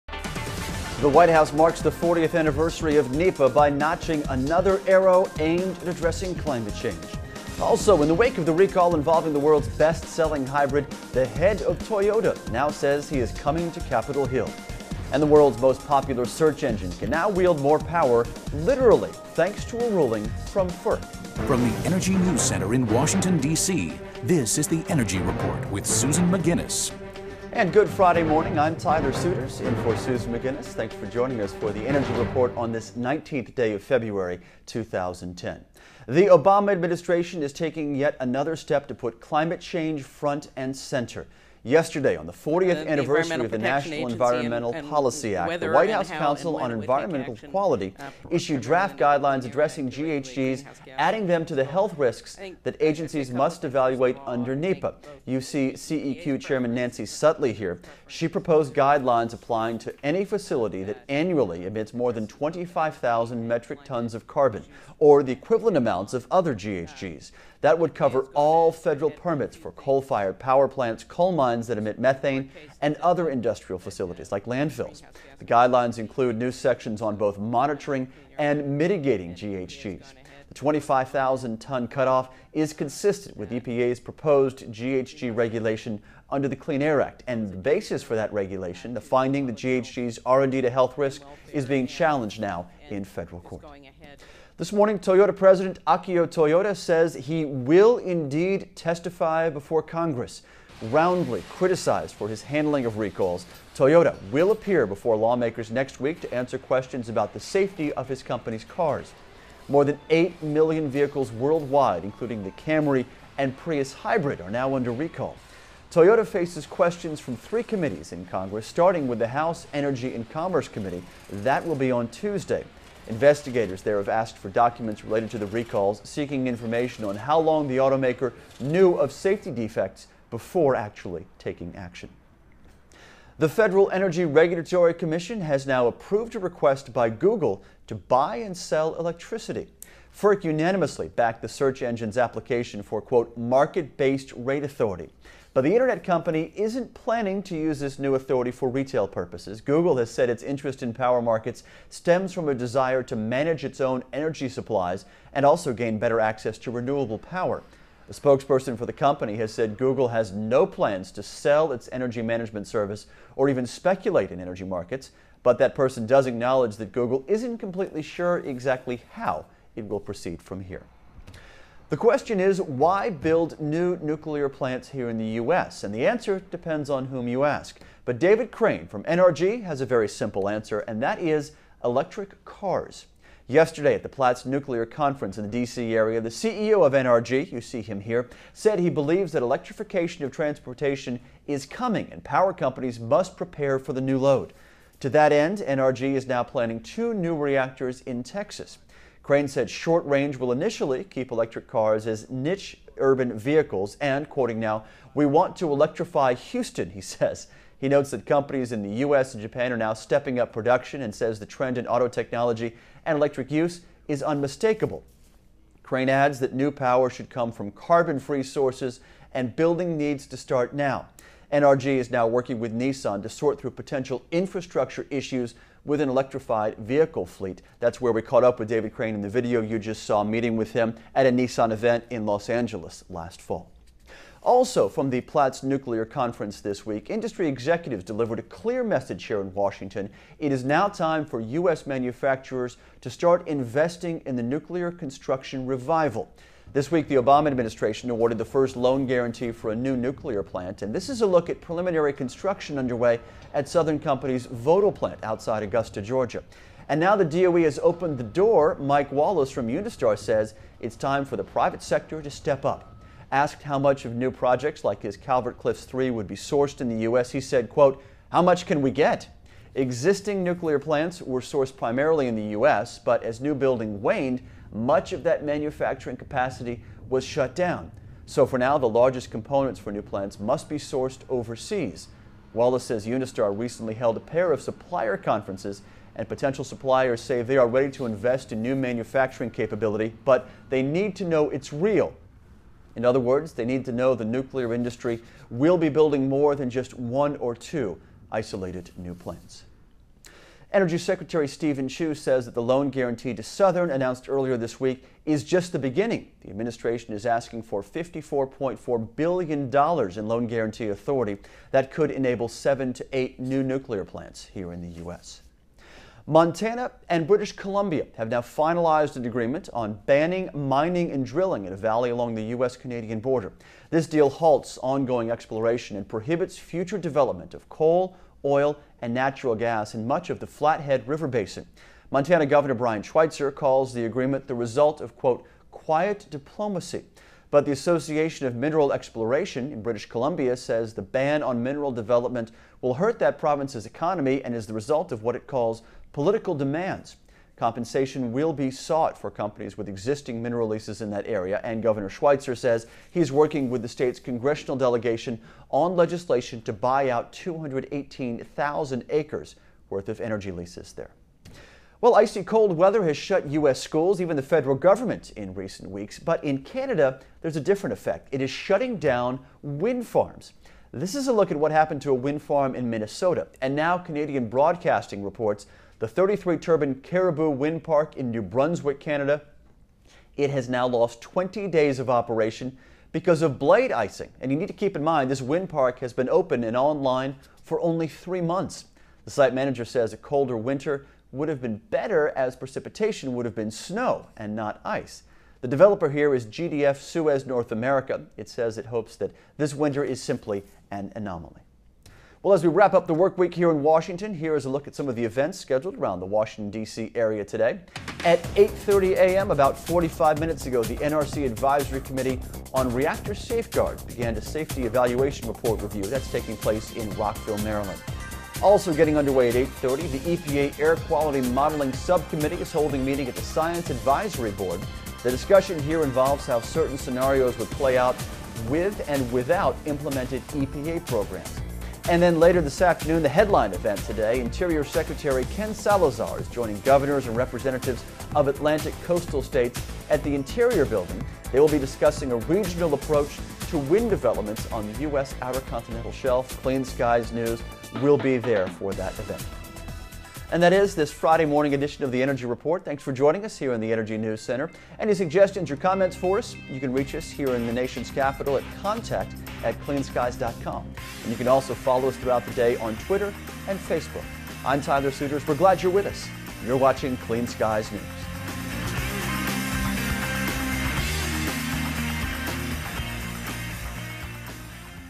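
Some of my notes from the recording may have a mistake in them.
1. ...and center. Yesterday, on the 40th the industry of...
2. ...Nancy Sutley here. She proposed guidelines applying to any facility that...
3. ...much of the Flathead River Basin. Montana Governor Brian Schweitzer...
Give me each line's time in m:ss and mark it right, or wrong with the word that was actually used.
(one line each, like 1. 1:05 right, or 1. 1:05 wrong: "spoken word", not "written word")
1. 0:40 wrong: "anniversary", not "industry"
2. 0:56 right
3. 5:30 right.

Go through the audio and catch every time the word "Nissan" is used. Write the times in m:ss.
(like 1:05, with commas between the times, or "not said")
3:42, 3:51.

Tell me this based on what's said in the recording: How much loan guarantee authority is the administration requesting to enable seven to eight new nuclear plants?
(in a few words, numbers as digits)
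$54.4 billion.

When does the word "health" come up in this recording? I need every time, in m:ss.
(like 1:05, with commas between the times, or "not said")
0:51, 1:30.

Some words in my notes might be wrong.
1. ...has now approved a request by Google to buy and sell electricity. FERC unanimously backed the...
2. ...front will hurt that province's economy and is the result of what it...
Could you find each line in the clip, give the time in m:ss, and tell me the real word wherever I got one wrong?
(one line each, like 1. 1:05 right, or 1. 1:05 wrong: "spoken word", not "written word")
1. 2:15 right
2. 5:41 wrong: "development", not "front".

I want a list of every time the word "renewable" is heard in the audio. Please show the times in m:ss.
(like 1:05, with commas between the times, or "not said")
2:36.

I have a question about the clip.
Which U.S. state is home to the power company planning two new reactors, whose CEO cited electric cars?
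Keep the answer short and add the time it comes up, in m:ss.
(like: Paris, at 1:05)
Texas, at 3:18.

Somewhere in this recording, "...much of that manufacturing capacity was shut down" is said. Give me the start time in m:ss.
4:34.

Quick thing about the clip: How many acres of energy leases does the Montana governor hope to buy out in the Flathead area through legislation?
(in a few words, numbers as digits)
218,000.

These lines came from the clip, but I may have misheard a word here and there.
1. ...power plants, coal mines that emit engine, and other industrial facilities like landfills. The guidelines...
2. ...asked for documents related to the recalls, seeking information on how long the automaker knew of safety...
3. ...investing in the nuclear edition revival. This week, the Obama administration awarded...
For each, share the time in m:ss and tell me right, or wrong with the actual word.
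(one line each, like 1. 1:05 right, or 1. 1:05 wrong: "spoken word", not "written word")
1. 1:10 wrong: "methane", not "engine"
2. 2:04 right
3. 4:03 wrong: "construction", not "edition".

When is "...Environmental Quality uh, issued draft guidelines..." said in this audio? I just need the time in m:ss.
0:46.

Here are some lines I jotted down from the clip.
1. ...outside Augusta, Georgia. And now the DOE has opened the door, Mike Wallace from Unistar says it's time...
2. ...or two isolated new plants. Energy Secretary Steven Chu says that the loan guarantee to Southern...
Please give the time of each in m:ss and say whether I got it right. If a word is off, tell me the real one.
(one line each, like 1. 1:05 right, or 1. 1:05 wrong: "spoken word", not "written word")
1. 4:15 right
2. 4:57 right.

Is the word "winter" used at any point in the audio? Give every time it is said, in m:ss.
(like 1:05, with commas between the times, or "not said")
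6:30, 6:39.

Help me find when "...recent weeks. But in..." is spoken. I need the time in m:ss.
6:05.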